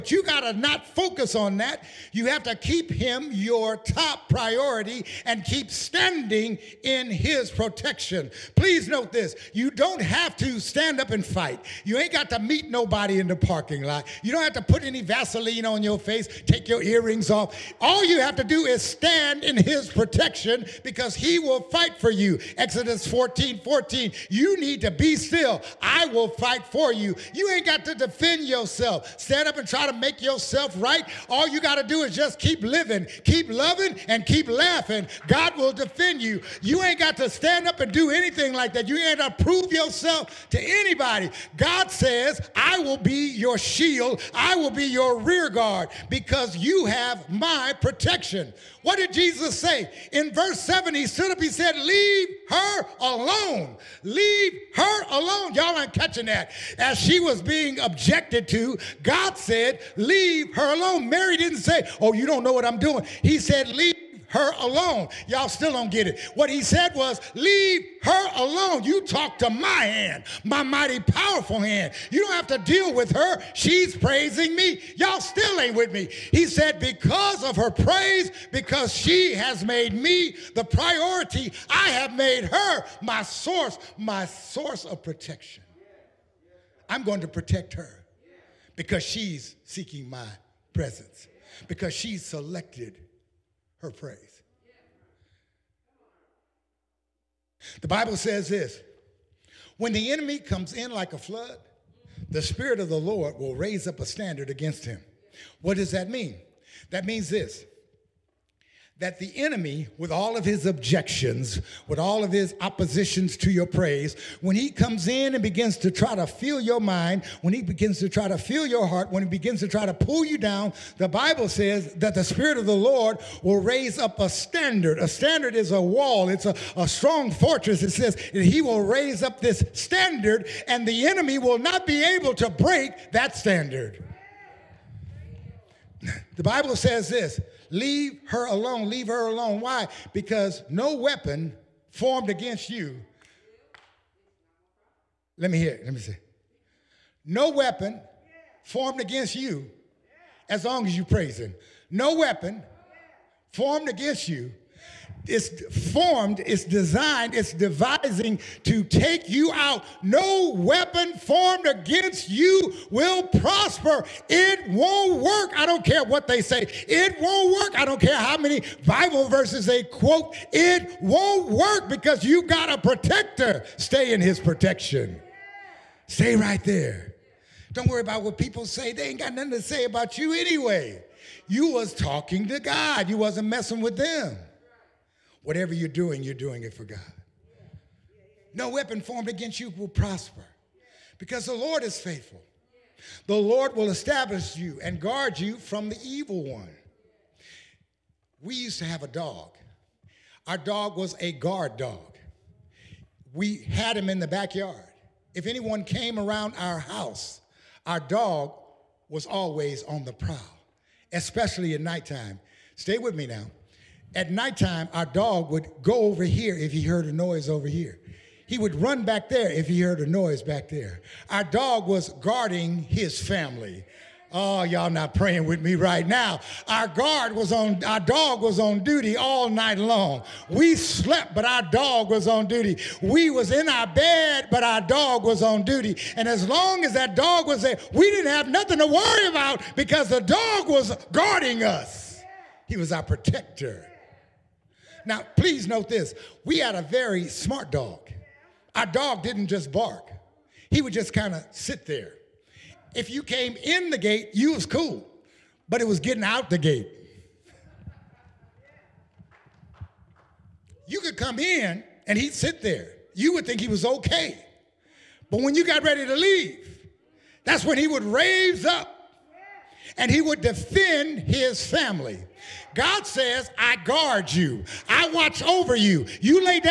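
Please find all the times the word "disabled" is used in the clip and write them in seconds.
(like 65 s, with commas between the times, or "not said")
not said.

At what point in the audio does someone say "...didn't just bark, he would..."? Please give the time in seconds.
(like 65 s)
249 s.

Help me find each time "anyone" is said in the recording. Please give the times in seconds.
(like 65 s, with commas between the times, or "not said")
205 s.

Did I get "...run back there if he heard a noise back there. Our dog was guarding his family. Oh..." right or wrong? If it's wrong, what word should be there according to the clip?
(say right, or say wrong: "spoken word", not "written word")
right.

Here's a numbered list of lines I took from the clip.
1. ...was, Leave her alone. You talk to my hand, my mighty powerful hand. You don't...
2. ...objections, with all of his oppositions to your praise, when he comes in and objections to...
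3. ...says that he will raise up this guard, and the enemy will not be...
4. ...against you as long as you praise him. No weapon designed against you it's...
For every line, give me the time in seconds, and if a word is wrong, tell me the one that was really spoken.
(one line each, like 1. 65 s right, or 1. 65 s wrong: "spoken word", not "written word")
1. 66 s right
2. 110 s wrong: "begins", not "objections"
3. 127 s wrong: "standard", not "guard"
4. 149 s wrong: "formed", not "designed".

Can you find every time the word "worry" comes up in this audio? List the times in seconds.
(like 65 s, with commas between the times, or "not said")
177 s, 238 s.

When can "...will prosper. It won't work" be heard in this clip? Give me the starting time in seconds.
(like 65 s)
162 s.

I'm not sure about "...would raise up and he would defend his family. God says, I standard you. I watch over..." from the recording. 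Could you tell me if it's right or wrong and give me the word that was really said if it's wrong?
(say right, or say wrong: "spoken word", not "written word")
wrong: "guard", not "standard".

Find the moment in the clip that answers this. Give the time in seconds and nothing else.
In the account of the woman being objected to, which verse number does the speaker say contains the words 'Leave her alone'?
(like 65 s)
50 s.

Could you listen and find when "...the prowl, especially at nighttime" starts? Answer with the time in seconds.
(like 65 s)
210 s.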